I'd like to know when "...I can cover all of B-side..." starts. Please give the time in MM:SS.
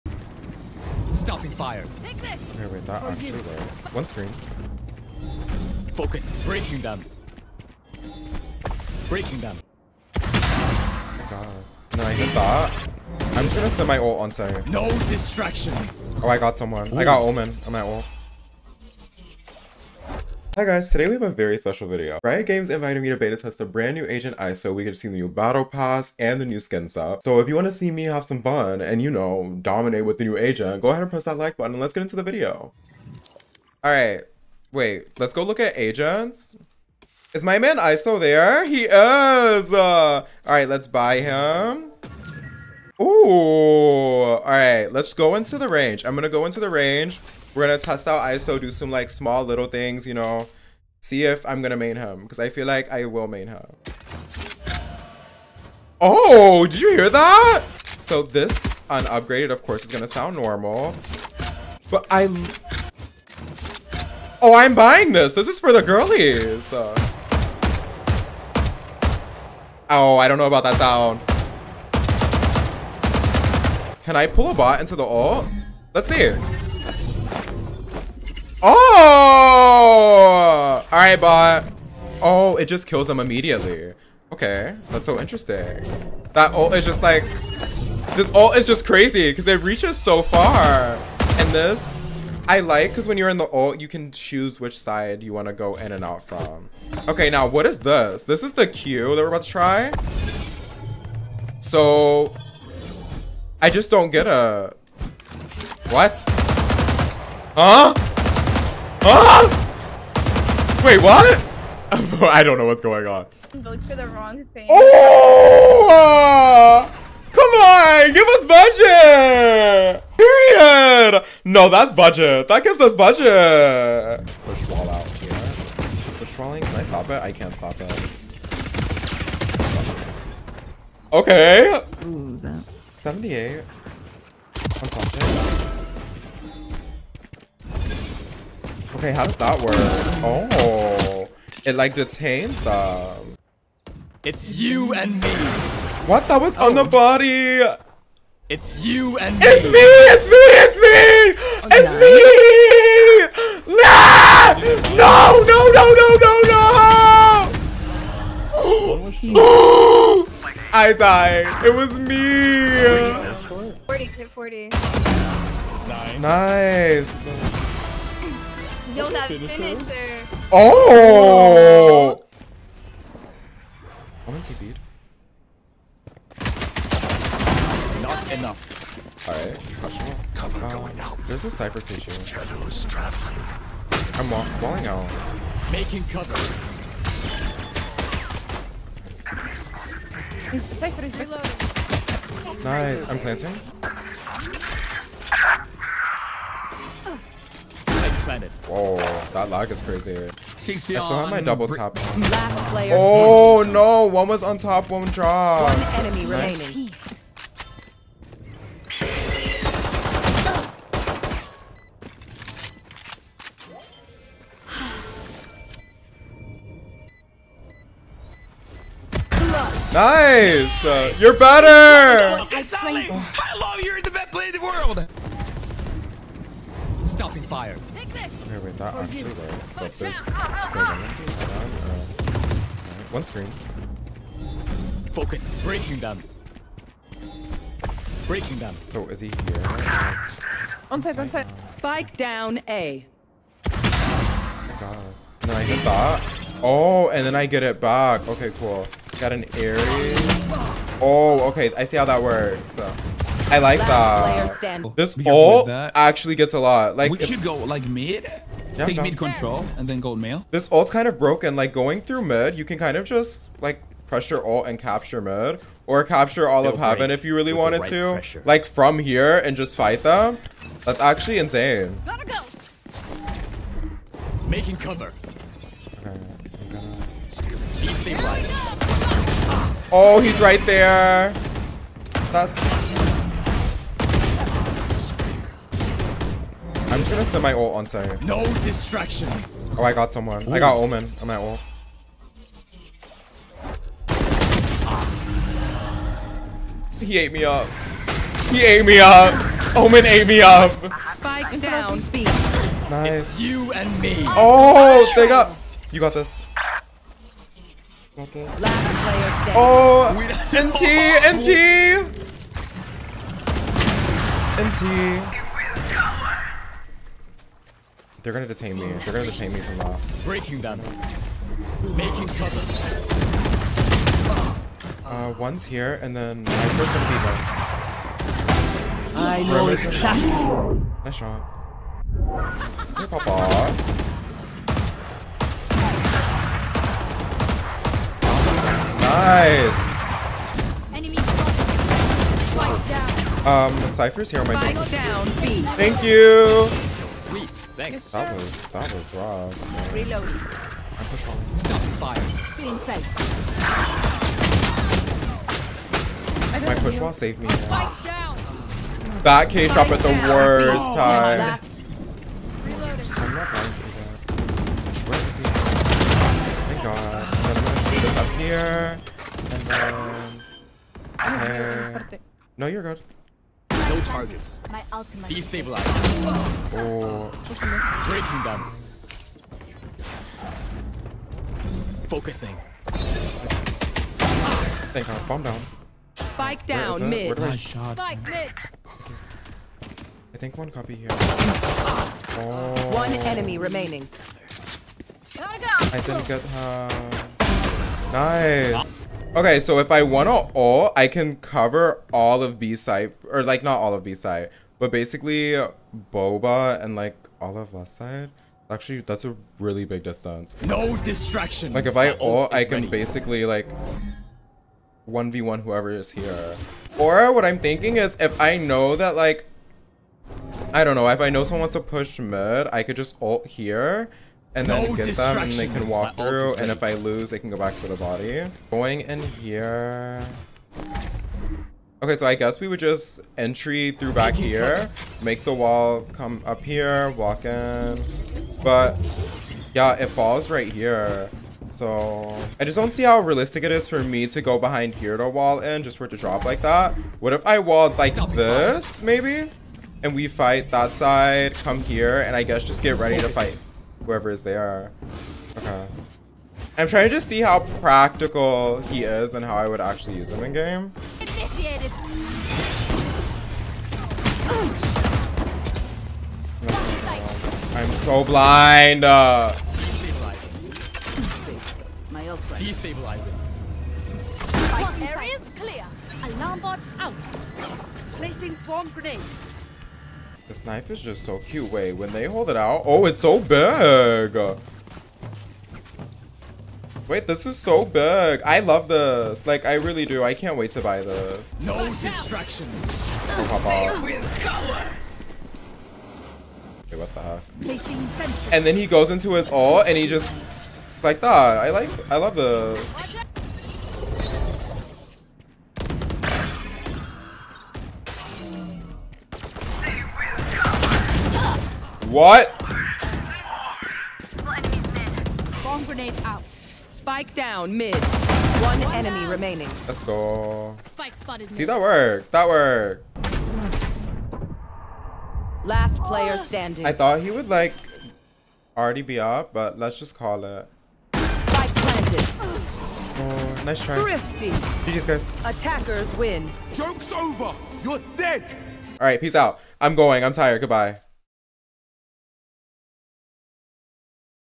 06:40.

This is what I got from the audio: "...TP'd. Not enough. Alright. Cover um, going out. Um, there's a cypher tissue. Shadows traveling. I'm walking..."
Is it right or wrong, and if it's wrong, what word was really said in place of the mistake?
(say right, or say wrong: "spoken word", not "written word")
right.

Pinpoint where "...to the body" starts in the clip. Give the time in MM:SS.
07:07.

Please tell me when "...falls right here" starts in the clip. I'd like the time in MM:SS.
07:20.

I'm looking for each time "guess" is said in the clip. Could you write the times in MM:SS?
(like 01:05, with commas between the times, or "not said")
07:12, 07:32.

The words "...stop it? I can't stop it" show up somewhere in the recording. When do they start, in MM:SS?
02:06.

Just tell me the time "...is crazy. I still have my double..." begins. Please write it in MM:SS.
03:19.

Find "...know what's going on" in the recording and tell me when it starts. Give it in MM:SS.
01:52.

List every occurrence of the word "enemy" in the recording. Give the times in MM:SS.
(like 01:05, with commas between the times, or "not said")
03:26, 06:33, 08:38.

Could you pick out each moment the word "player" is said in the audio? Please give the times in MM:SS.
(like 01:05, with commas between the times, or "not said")
03:44, 08:46.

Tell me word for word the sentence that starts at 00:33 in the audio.
All right, wait, let's go look at agents.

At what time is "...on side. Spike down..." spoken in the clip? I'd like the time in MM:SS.
04:01.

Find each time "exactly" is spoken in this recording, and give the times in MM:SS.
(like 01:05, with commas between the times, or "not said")
03:42, 05:29.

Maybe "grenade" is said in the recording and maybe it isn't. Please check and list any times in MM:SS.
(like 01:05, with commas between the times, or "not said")
07:58, 08:35.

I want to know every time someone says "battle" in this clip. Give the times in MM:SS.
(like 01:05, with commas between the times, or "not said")
00:25.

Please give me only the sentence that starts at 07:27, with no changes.
What if I walled like this maybe?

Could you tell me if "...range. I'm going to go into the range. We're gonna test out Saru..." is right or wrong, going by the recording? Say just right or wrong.
wrong.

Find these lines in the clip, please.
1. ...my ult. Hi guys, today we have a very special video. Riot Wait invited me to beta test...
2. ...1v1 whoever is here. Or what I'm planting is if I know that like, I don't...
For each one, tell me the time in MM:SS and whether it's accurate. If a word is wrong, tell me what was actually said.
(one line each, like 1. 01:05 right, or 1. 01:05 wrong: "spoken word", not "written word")
1. 00:17 wrong: "Games", not "Wait"
2. 06:55 wrong: "thinking", not "planting".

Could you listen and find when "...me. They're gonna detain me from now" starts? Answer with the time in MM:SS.
05:18.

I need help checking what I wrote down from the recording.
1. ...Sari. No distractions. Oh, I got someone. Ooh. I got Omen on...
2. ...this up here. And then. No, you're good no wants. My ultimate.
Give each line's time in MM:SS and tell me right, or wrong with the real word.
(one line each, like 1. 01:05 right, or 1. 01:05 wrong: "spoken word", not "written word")
1. 04:47 right
2. 06:08 wrong: "targets", not "wants".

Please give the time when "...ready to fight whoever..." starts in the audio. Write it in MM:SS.
07:32.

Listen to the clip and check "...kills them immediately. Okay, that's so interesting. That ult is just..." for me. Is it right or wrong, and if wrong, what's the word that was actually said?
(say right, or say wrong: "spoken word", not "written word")
right.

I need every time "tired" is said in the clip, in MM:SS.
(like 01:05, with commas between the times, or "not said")
09:00.